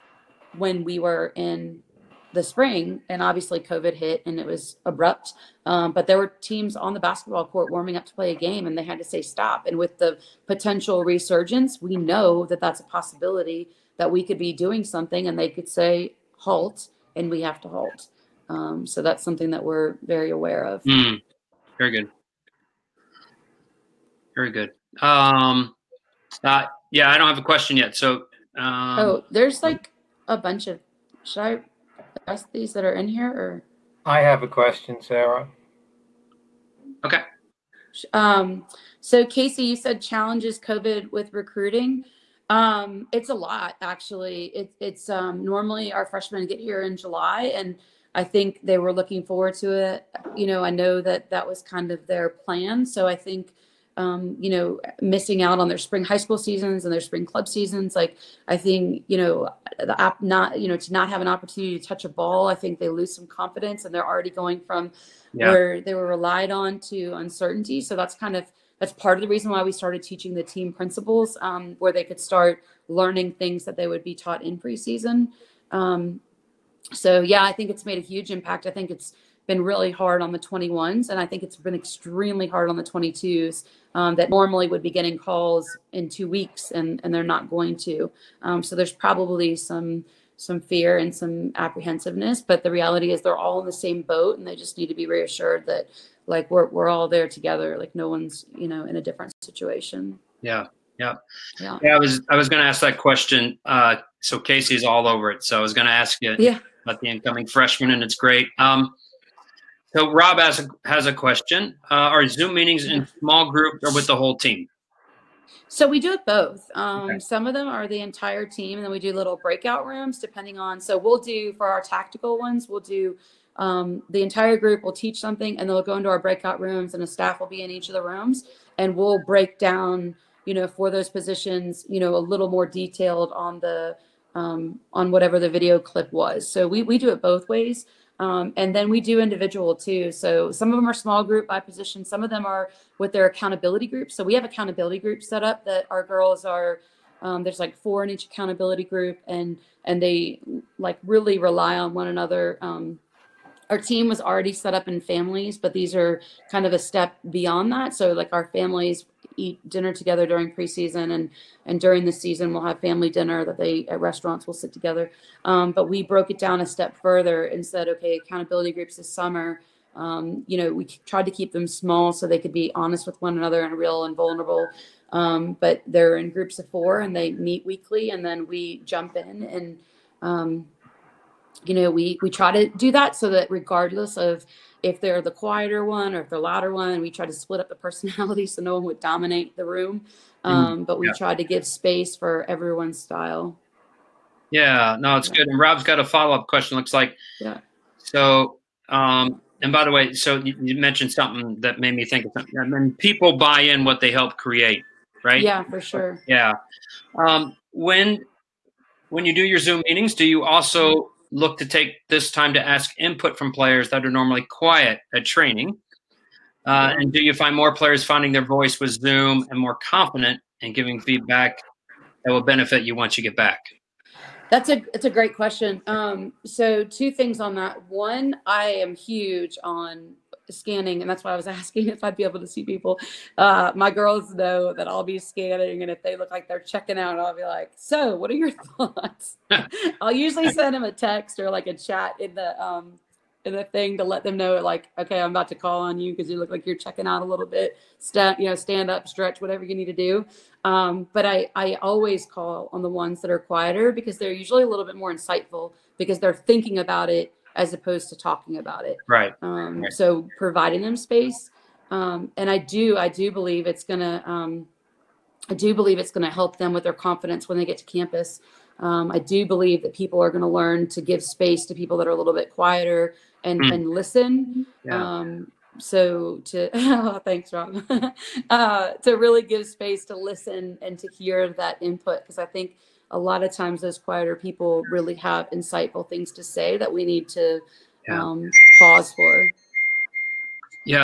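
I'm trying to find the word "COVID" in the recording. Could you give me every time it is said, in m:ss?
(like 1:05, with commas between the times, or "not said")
0:03, 0:40.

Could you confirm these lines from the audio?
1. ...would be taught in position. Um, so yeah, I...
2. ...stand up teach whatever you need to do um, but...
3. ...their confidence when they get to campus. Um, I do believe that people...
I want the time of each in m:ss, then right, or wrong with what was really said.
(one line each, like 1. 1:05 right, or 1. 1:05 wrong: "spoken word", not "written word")
1. 1:13 wrong: "preseason", not "position"
2. 4:08 wrong: "stretch", not "teach"
3. 4:26 right.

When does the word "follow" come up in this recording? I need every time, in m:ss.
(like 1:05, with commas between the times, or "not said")
3:16.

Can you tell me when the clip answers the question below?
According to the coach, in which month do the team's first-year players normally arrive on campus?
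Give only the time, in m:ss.
0:46.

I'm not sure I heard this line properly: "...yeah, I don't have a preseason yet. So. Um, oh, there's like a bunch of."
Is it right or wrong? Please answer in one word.
wrong.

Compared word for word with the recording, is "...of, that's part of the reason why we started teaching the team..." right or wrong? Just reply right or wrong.
right.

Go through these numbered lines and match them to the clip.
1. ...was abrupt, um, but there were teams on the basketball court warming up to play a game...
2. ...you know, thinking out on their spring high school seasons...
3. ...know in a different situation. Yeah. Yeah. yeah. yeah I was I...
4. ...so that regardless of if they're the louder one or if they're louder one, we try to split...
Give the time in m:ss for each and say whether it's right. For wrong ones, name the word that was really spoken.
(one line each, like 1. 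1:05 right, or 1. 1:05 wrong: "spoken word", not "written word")
1. 0:04 right
2. 0:54 wrong: "missing", not "thinking"
3. 1:38 right
4. 3:03 wrong: "quieter", not "louder".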